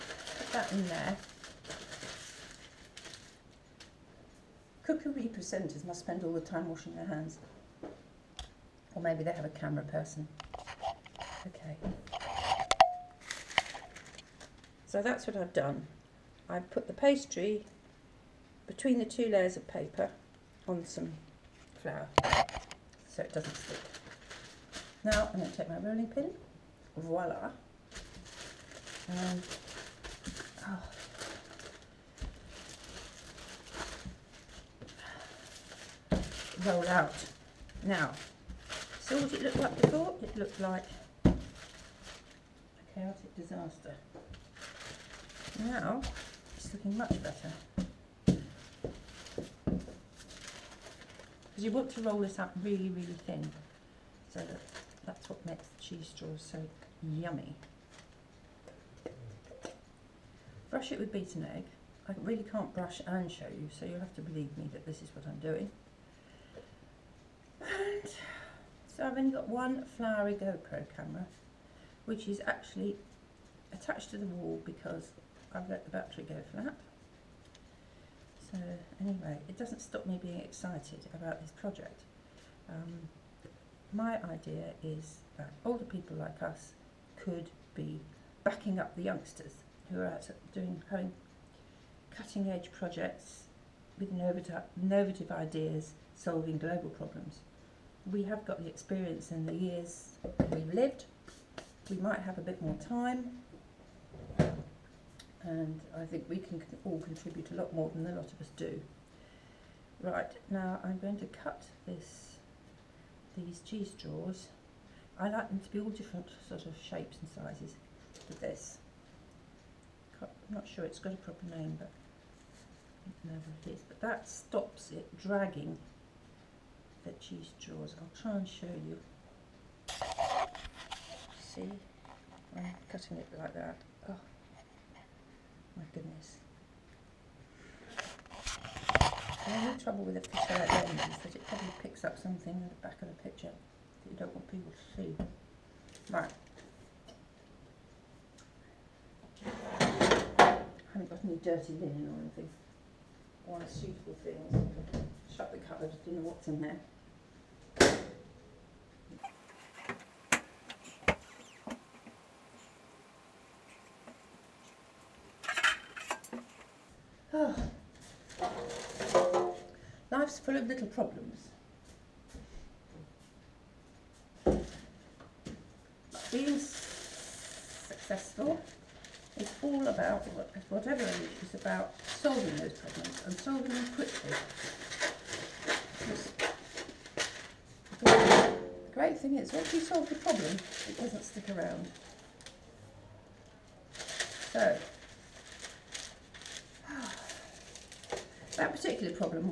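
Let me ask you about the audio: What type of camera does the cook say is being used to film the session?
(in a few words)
GoPro.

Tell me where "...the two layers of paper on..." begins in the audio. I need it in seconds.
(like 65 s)
18 s.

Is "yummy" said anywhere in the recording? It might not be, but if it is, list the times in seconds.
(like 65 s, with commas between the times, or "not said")
57 s.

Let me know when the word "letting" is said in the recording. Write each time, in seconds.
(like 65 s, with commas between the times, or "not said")
not said.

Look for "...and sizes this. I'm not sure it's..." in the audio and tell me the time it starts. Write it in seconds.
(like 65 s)
117 s.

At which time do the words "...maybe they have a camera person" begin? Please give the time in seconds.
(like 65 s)
9 s.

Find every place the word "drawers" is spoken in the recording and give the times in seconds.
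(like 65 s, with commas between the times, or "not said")
113 s, 127 s.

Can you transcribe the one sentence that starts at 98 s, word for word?
We have got the experience in the years we've lived.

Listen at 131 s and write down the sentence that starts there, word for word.
See, I'm cutting it like that.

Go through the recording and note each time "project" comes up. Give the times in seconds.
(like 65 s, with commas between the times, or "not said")
81 s, 92 s.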